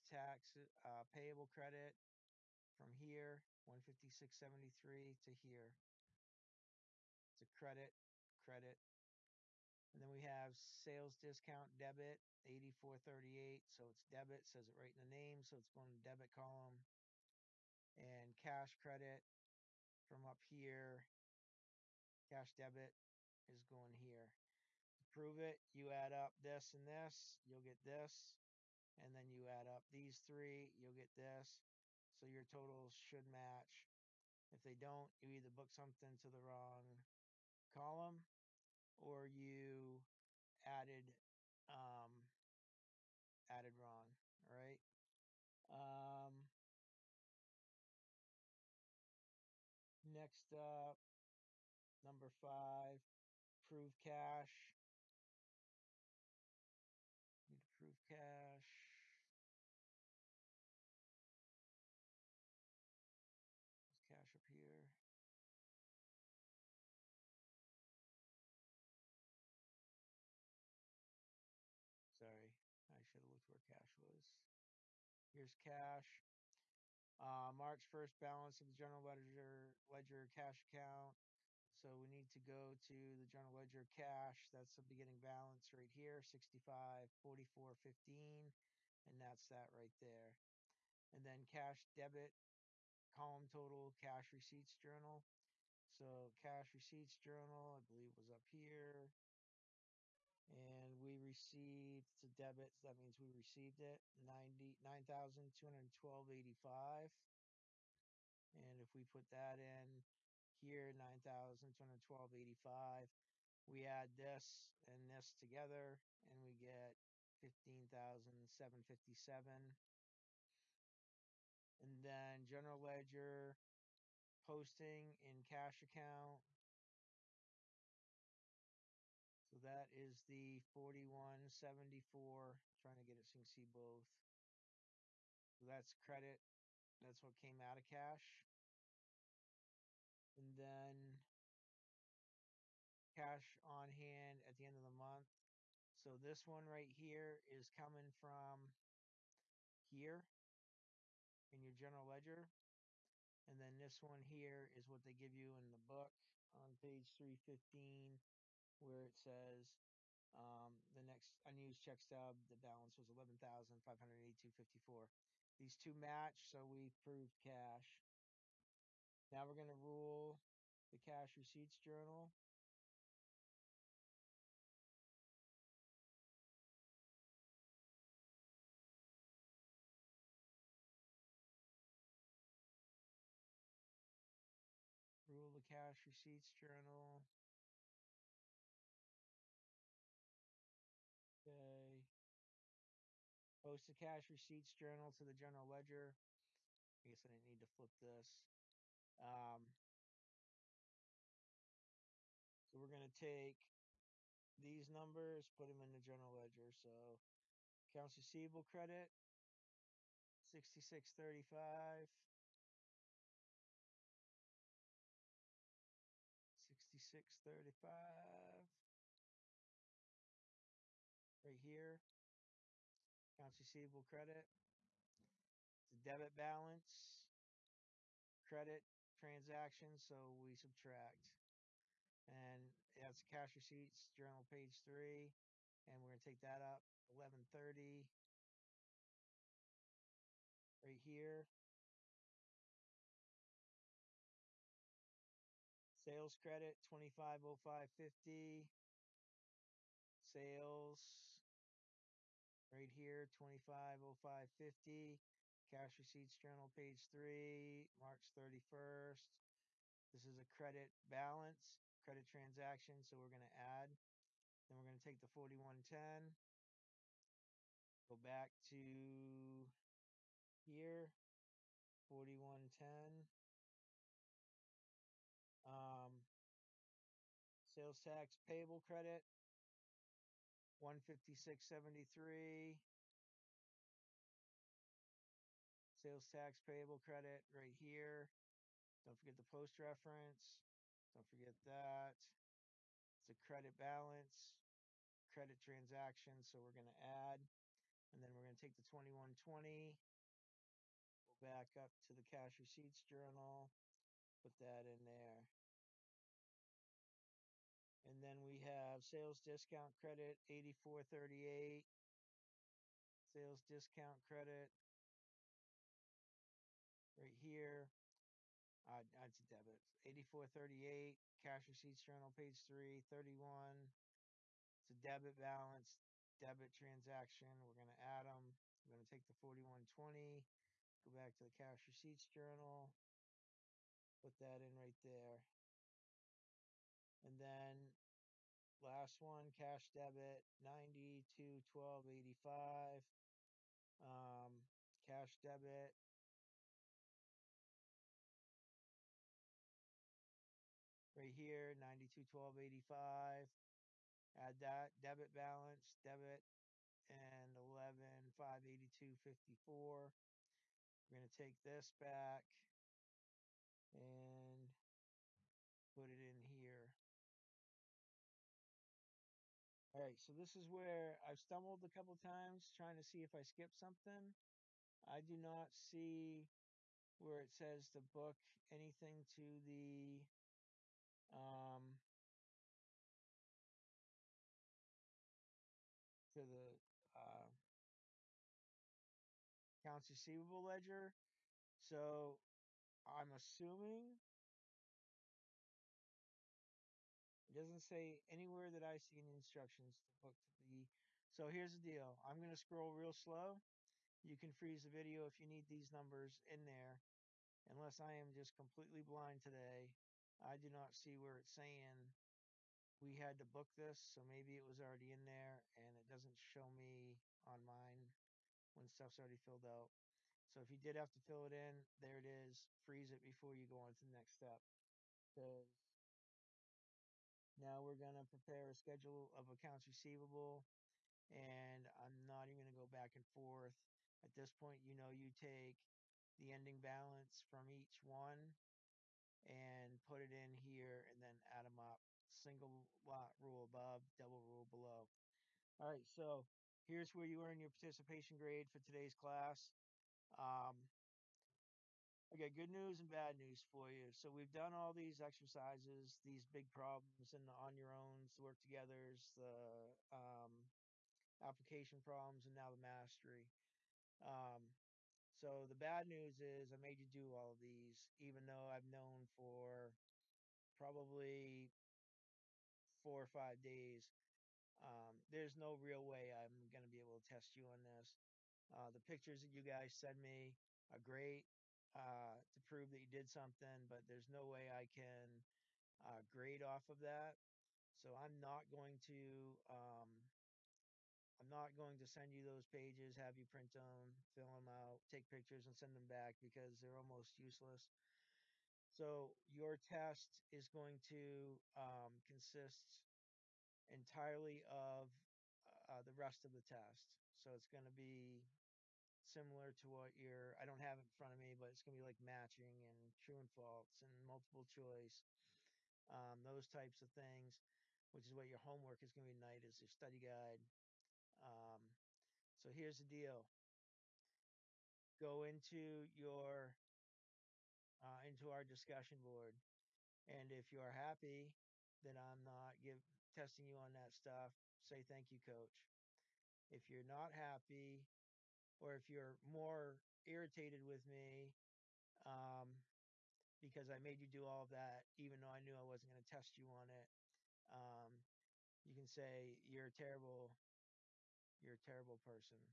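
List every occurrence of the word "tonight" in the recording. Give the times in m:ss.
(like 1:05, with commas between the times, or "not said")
8:39.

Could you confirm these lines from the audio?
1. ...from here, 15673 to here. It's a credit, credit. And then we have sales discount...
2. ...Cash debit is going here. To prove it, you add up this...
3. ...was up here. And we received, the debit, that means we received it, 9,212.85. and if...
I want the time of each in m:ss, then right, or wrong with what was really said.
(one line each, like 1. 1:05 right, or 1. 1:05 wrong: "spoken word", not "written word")
1. 0:02 right
2. 0:22 right
3. 1:38 right.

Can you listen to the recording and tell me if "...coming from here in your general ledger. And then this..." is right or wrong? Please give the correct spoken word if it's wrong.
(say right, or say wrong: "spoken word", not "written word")
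right.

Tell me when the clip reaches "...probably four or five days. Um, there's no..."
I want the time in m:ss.
7:50.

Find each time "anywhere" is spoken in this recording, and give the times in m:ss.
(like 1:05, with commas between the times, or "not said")
6:38.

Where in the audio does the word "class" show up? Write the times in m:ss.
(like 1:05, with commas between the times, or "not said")
7:29.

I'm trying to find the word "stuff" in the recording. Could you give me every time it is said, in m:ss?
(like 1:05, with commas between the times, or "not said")
6:58, 8:54.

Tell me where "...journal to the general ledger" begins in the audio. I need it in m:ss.
3:14.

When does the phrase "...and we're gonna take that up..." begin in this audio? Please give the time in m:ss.
3:55.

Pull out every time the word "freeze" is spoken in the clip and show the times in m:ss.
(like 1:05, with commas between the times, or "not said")
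6:44, 7:02.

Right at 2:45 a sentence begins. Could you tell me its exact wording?
These two match, so we proved cash.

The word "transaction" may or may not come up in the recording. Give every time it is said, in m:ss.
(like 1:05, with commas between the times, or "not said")
3:49, 4:22, 4:55, 5:26.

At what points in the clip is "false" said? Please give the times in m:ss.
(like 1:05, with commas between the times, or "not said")
8:33.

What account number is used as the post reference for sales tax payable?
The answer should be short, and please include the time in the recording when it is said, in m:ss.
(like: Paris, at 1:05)
2120, at 4:58.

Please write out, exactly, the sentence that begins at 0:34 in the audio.
If they don't, you either book something to the wrong column or you added um, added wrong.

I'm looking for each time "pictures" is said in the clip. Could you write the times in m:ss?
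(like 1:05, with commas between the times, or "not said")
7:59, 8:15.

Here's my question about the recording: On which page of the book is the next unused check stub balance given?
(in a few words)
315.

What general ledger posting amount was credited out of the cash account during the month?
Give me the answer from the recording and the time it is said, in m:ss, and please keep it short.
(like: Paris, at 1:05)
4174, at 2:10.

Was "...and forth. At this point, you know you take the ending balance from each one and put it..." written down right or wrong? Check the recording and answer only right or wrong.
right.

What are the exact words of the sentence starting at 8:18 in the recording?
So your test is going to um, consist entirely of uh, the rest of the test.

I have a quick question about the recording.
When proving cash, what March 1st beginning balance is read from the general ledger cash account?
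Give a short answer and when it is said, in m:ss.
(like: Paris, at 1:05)
65,44,15, at 1:26.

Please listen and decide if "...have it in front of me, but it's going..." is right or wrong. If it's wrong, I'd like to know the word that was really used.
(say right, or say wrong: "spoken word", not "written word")
right.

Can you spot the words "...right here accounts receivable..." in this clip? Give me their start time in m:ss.
3:41.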